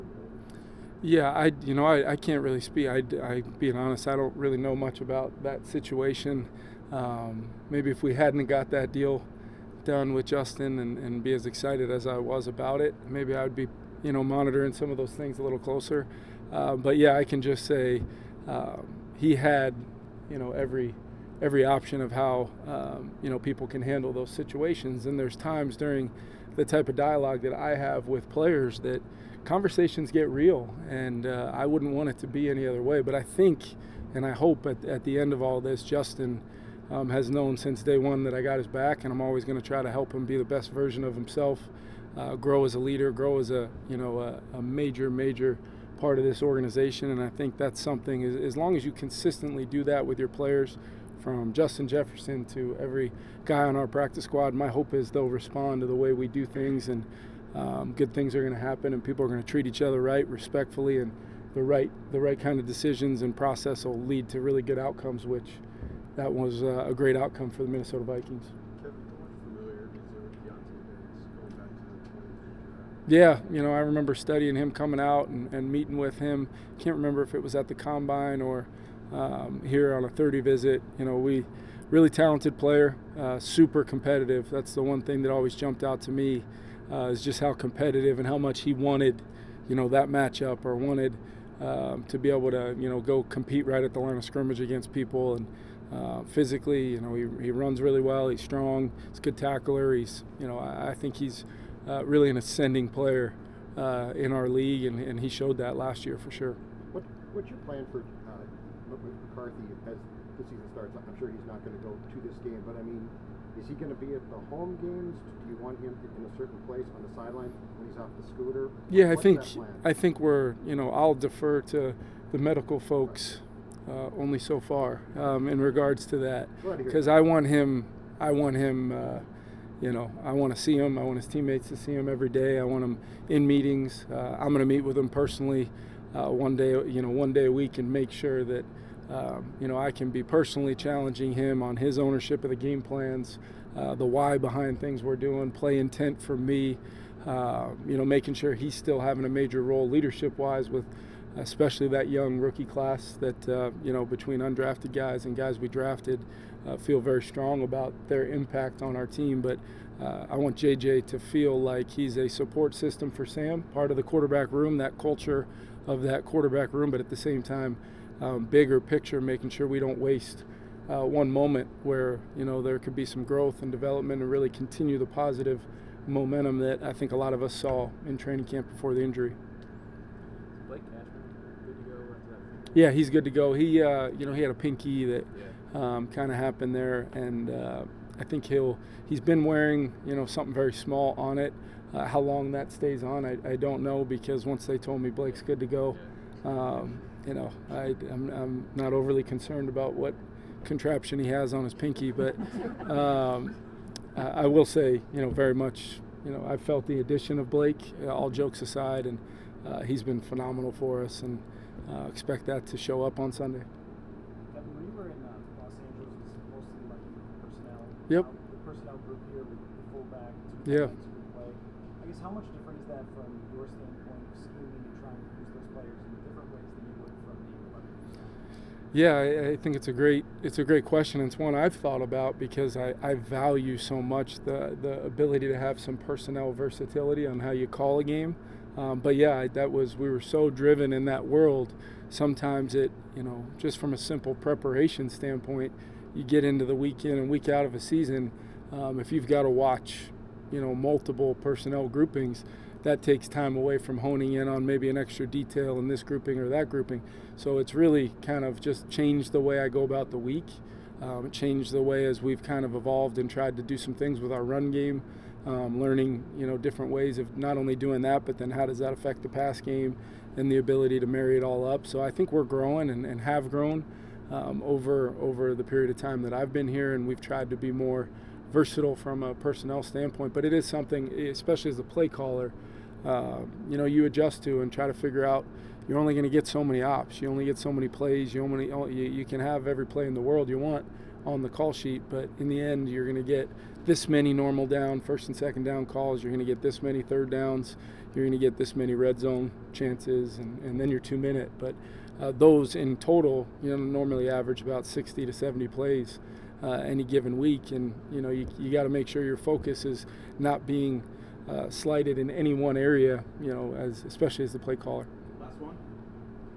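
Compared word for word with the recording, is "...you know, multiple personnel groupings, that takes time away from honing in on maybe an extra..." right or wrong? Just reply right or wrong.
right.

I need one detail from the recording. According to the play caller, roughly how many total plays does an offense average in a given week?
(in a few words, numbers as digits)
60 to 70.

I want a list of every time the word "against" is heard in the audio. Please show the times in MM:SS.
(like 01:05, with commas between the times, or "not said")
01:34.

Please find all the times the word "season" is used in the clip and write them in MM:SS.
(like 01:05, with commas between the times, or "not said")
01:50, 04:07.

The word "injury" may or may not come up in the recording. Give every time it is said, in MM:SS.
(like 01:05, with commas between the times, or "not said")
02:59.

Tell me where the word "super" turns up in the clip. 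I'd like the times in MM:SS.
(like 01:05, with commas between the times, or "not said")
01:23.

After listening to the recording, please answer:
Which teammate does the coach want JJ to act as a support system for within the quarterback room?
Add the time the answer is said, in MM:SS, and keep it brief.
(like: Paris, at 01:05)
Sam, at 02:43.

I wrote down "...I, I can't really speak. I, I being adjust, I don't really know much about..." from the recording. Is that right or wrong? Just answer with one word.
wrong.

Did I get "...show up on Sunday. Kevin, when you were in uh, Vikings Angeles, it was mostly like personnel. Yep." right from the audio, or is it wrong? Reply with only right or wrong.
wrong.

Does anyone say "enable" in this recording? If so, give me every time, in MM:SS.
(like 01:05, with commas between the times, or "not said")
not said.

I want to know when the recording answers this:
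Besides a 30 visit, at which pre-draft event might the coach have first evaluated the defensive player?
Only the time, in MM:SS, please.
01:17.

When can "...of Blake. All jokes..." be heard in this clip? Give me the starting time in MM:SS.
03:27.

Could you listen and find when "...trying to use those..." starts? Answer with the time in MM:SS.
03:44.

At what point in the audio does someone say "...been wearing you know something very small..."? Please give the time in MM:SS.
03:09.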